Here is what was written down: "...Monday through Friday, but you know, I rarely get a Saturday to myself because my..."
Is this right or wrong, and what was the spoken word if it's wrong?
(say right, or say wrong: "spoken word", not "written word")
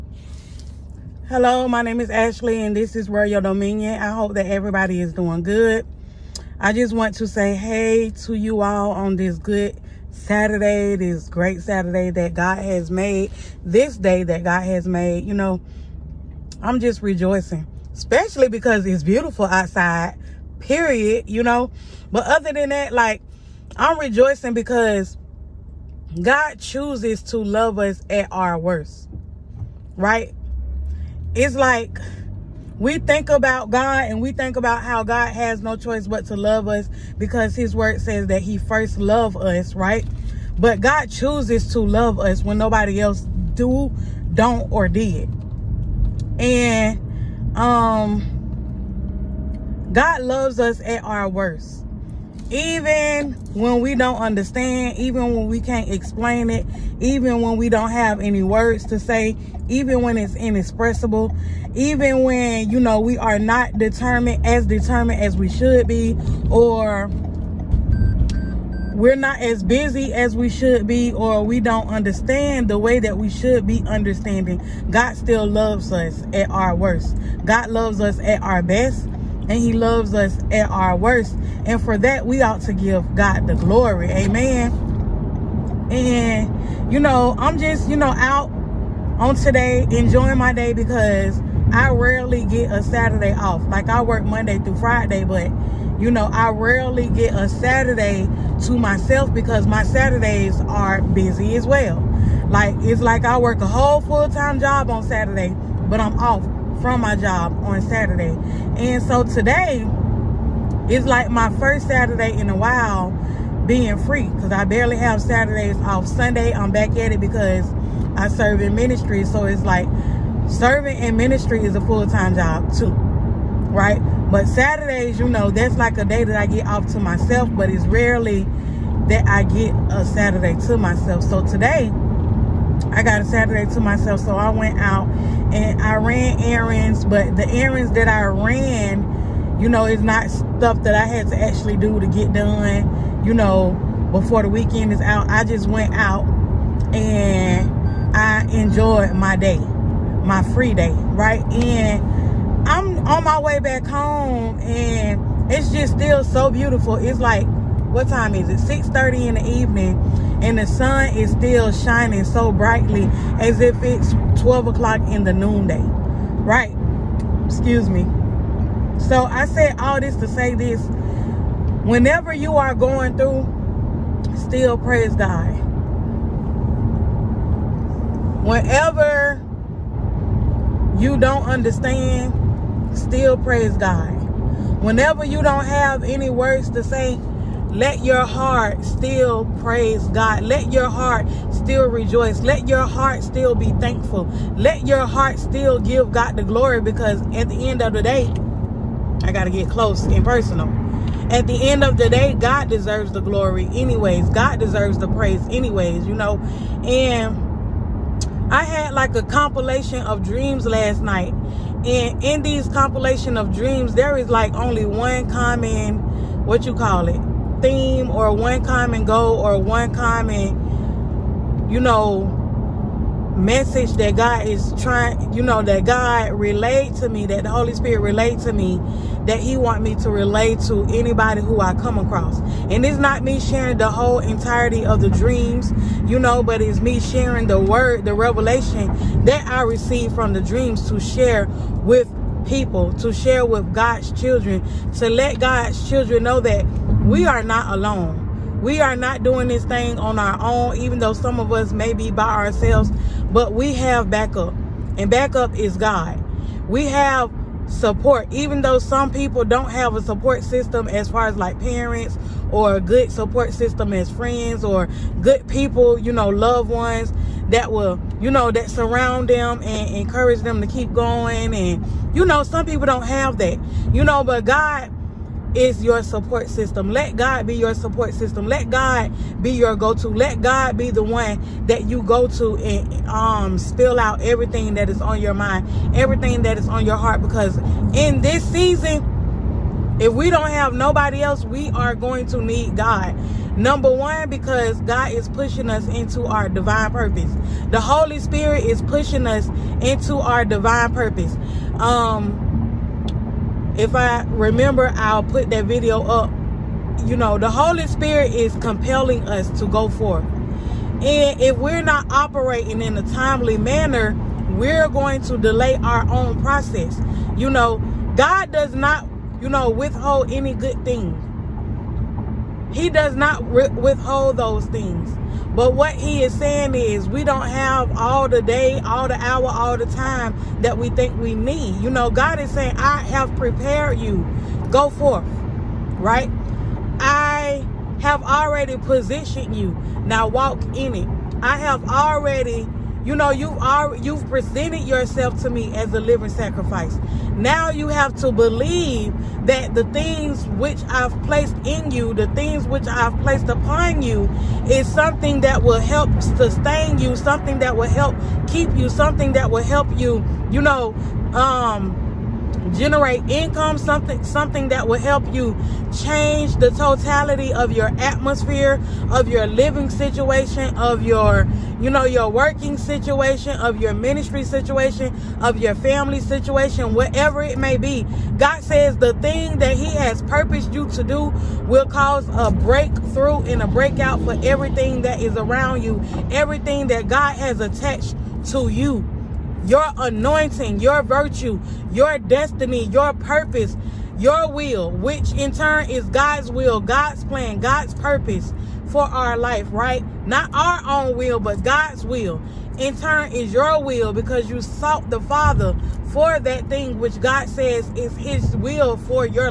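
right.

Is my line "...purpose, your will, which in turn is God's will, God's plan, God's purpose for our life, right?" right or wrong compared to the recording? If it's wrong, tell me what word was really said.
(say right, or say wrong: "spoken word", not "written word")
right.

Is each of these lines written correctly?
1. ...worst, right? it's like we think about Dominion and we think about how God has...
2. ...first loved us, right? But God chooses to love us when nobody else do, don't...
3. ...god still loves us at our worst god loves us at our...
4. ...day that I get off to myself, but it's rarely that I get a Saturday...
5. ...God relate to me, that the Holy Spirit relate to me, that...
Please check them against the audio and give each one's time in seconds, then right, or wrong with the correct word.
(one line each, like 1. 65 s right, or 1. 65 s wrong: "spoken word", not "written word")
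1. 28 s wrong: "God", not "Dominion"
2. 38 s right
3. 74 s right
4. 126 s right
5. 225 s right.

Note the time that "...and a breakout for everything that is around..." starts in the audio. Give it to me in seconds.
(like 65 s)
383 s.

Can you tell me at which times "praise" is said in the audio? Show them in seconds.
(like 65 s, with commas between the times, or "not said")
174 s, 183 s, 189 s, 205 s.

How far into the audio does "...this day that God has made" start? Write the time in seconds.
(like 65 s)
13 s.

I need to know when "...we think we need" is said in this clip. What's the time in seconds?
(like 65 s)
330 s.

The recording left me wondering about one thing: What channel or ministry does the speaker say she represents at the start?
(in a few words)
Royal Dominion.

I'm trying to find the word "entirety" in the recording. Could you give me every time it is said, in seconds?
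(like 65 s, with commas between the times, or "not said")
234 s.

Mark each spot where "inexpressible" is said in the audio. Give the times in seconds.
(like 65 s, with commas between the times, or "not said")
60 s.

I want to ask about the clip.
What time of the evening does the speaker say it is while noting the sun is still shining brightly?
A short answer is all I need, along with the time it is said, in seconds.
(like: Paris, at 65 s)
6:30, at 158 s.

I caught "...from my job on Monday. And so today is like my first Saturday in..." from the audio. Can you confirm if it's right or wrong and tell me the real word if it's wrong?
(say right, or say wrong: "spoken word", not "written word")
wrong: "Saturday", not "Monday".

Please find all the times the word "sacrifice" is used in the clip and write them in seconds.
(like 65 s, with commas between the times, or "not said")
346 s.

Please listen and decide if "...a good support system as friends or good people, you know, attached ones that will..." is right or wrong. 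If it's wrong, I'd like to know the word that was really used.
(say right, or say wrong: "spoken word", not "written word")
wrong: "loved", not "attached".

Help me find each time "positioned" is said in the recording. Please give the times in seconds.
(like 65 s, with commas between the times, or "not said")
338 s.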